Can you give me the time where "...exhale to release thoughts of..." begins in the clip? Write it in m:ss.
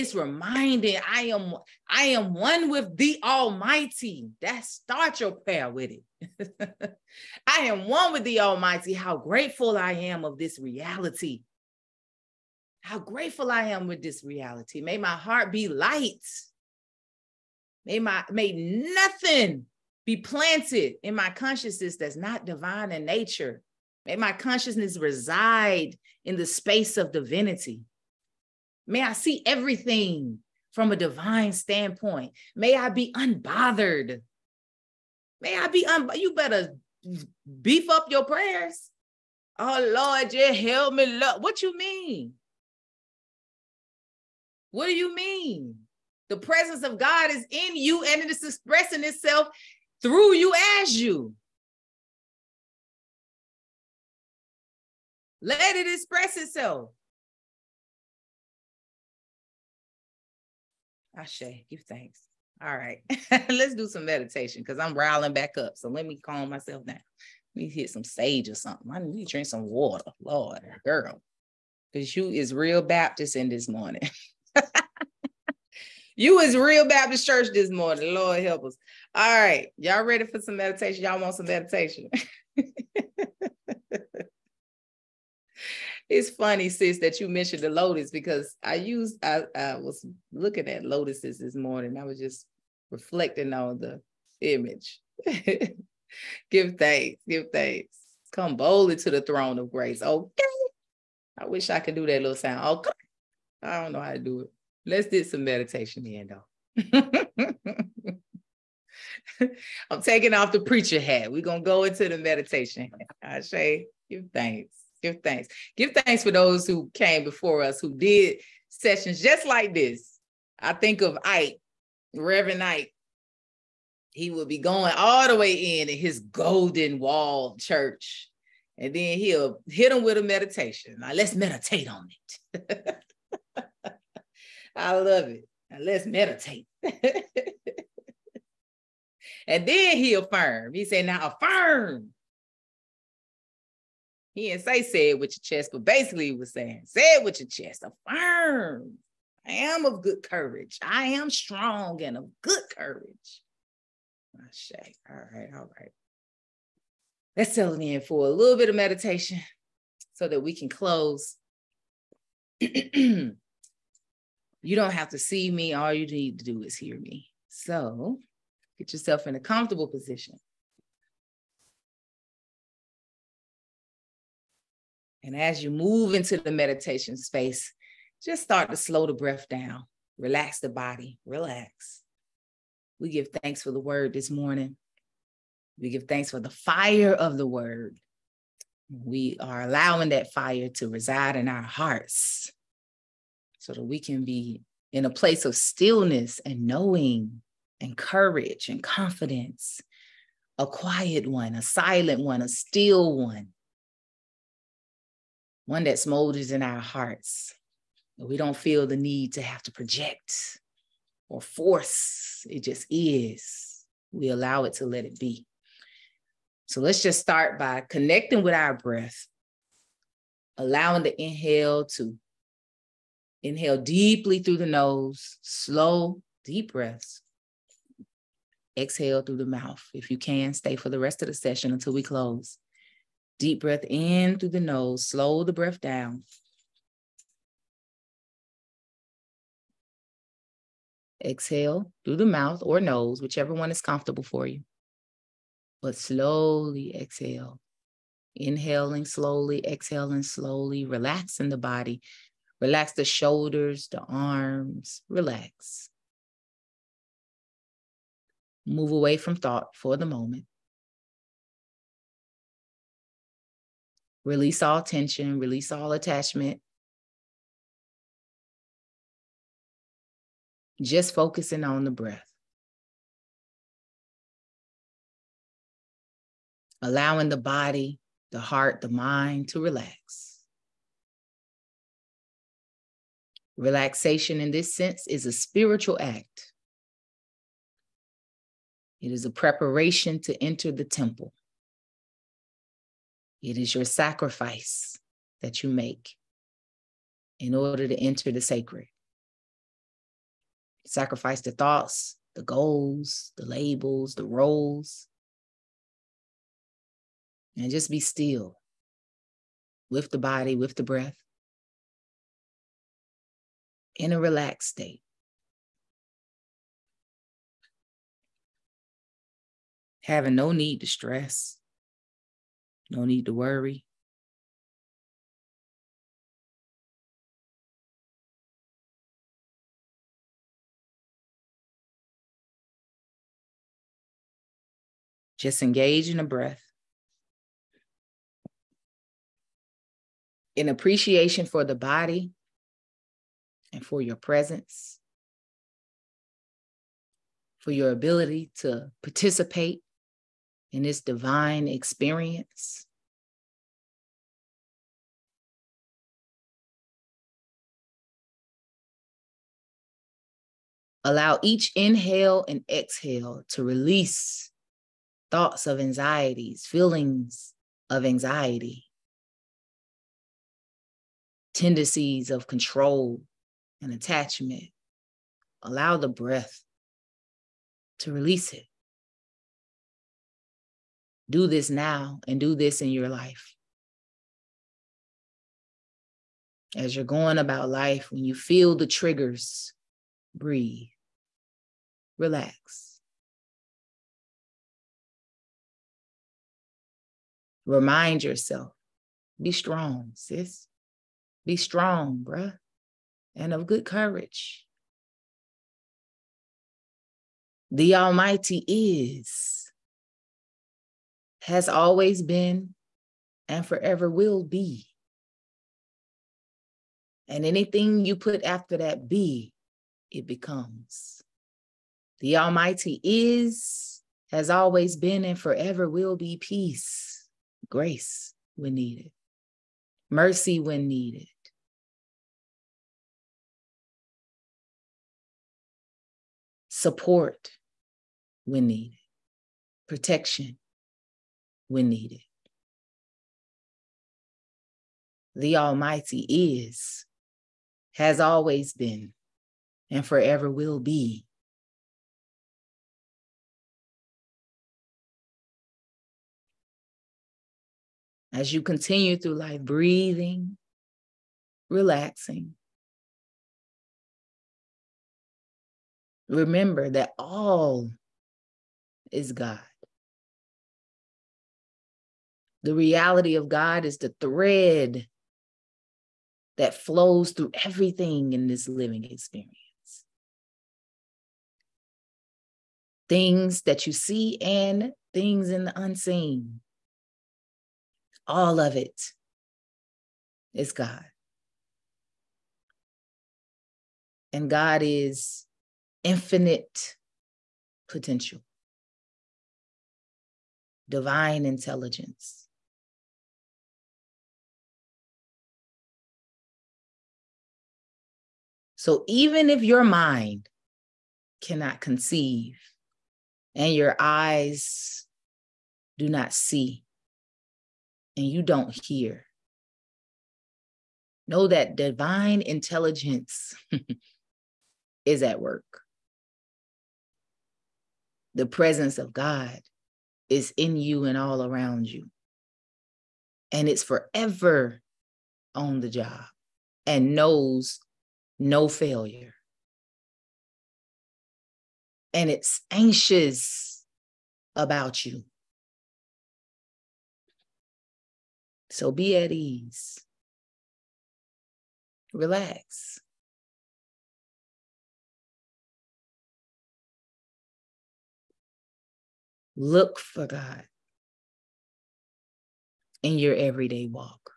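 6:02.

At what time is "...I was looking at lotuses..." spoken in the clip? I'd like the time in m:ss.
1:29.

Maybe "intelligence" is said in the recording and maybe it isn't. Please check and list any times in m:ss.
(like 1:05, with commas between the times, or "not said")
8:21, 8:42.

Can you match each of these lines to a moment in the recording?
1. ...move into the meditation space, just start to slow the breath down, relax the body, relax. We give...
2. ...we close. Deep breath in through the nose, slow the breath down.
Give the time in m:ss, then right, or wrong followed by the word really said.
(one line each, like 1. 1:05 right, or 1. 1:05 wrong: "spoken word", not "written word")
1. 2:55 right
2. 3:51 right.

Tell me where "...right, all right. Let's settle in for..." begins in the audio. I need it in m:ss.
2:35.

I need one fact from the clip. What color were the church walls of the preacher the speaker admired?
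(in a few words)
golden.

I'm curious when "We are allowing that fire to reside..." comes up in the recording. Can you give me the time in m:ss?
3:08.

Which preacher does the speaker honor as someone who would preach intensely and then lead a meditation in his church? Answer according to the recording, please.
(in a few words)
Reverend Ike.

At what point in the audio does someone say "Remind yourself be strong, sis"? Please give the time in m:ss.
6:37.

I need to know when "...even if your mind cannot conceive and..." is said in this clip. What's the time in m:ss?
8:29.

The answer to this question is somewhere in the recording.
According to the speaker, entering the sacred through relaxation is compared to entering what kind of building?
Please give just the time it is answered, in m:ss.
4:50.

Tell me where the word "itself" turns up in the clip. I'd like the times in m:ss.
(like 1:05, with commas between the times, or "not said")
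0:49, 0:56.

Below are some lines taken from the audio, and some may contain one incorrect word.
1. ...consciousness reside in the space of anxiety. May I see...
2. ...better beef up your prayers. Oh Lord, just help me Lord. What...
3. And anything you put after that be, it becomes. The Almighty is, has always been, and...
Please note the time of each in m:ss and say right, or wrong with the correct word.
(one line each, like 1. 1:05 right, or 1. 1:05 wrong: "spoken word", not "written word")
1. 0:24 wrong: "divinity", not "anxiety"
2. 0:36 right
3. 6:57 right.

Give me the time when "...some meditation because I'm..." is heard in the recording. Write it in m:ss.
1:03.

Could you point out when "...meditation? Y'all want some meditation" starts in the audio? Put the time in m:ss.
1:20.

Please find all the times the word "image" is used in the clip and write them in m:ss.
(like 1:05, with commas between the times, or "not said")
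1:34.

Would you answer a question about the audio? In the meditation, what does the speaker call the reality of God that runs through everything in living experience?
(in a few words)
the thread.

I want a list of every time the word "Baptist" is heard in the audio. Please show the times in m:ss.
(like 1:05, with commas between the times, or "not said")
1:12, 1:16.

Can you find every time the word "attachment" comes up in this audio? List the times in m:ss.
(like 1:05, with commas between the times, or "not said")
4:25, 6:13.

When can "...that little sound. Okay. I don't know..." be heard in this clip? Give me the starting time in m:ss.
1:42.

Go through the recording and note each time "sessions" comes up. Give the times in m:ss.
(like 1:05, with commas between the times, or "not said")
1:58, 3:51.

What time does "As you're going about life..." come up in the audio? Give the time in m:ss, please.
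6:26.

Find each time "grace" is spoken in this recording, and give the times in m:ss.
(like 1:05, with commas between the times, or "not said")
1:39, 7:07.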